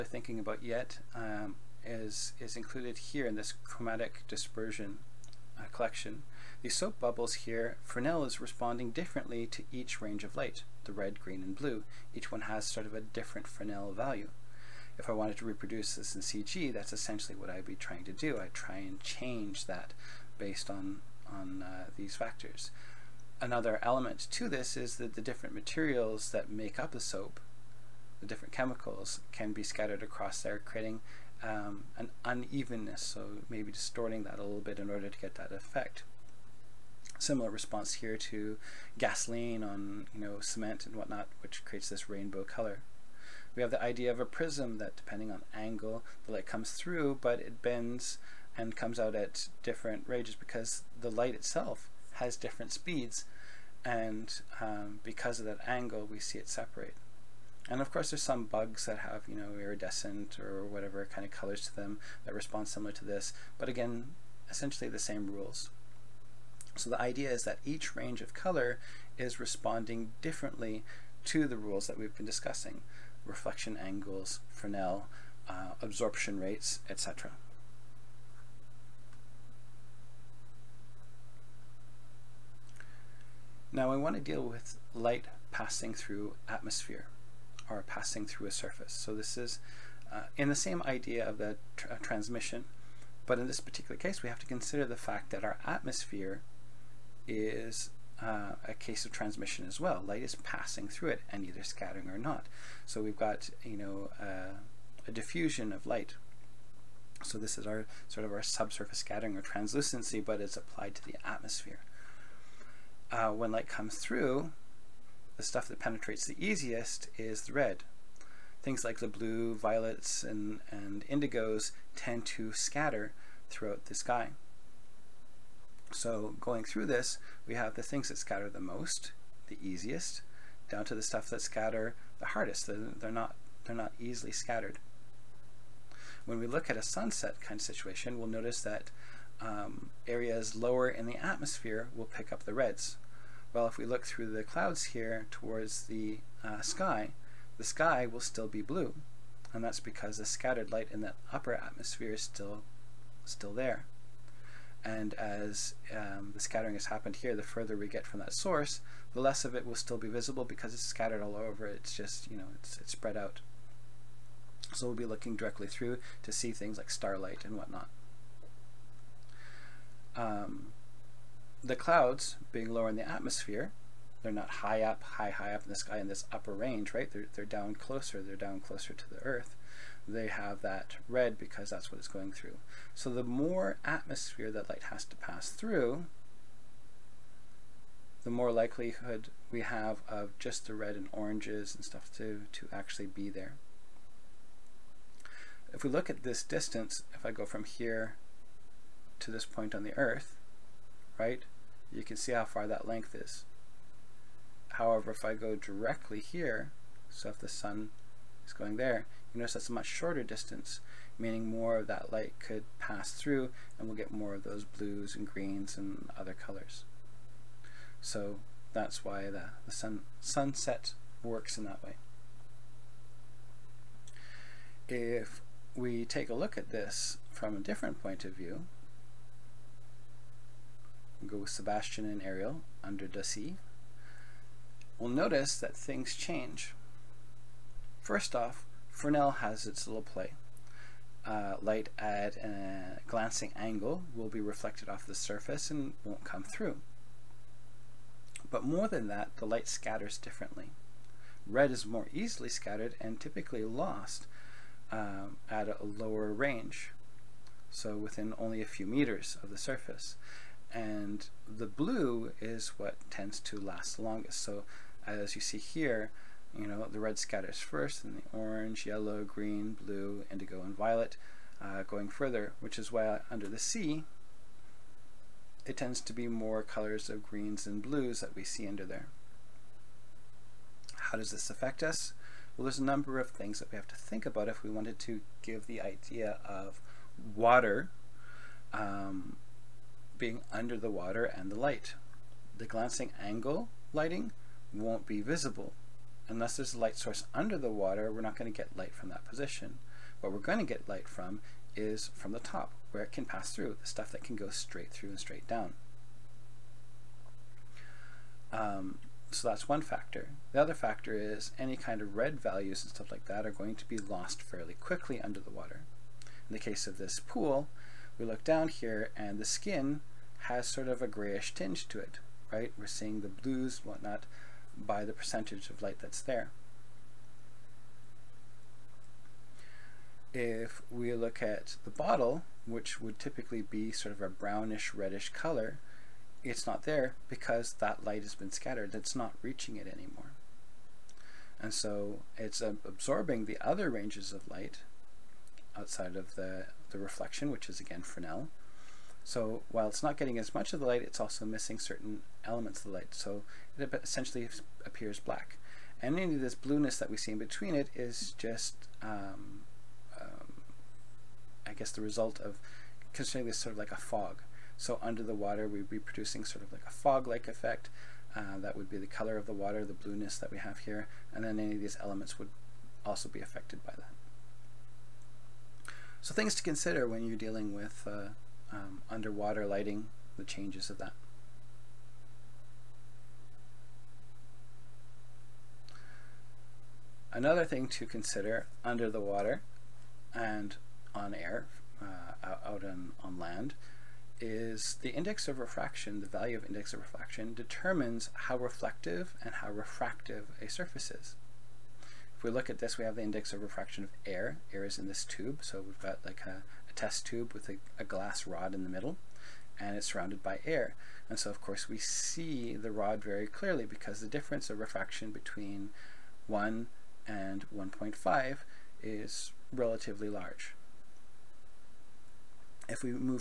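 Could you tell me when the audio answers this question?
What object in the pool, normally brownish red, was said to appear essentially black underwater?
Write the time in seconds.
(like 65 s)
331 s.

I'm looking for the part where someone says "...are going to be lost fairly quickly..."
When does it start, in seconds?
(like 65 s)
313 s.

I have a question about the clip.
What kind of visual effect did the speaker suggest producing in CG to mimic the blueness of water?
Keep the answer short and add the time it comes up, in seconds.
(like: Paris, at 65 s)
A fog-like effect, at 366 s.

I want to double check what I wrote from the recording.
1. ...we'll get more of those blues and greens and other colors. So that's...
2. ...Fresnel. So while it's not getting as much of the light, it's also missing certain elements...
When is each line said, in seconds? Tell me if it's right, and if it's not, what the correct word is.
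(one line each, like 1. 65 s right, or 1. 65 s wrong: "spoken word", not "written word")
1. 213 s right
2. 348 s right.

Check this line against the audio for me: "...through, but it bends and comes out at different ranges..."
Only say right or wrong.
right.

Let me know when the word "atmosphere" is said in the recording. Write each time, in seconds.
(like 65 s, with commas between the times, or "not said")
86 s, 95 s, 111 s, 141 s, 151 s, 173 s, 183 s.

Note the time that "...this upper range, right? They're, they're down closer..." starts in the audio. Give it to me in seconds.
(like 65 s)
176 s.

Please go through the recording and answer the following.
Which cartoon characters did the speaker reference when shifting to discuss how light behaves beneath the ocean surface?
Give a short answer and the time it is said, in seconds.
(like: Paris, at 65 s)
Sebastian and Ariel, at 231 s.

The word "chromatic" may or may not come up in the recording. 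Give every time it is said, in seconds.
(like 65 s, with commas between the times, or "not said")
3 s.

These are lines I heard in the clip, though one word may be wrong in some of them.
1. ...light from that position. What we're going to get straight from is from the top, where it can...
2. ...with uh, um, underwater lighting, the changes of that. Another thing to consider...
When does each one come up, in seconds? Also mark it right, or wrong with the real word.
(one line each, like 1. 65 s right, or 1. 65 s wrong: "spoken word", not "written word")
1. 298 s wrong: "light", not "straight"
2. 377 s right.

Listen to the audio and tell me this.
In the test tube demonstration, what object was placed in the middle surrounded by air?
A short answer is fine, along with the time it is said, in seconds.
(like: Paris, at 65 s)
A glass rod, at 408 s.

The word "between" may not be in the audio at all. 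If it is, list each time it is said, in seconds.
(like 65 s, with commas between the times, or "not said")
357 s, 415 s.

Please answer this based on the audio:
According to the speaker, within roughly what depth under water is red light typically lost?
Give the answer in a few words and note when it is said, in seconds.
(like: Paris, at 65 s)
A few meters, at 258 s.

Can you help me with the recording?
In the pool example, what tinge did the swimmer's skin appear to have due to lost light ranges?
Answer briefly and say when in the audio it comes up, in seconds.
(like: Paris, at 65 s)
Grayish, at 321 s.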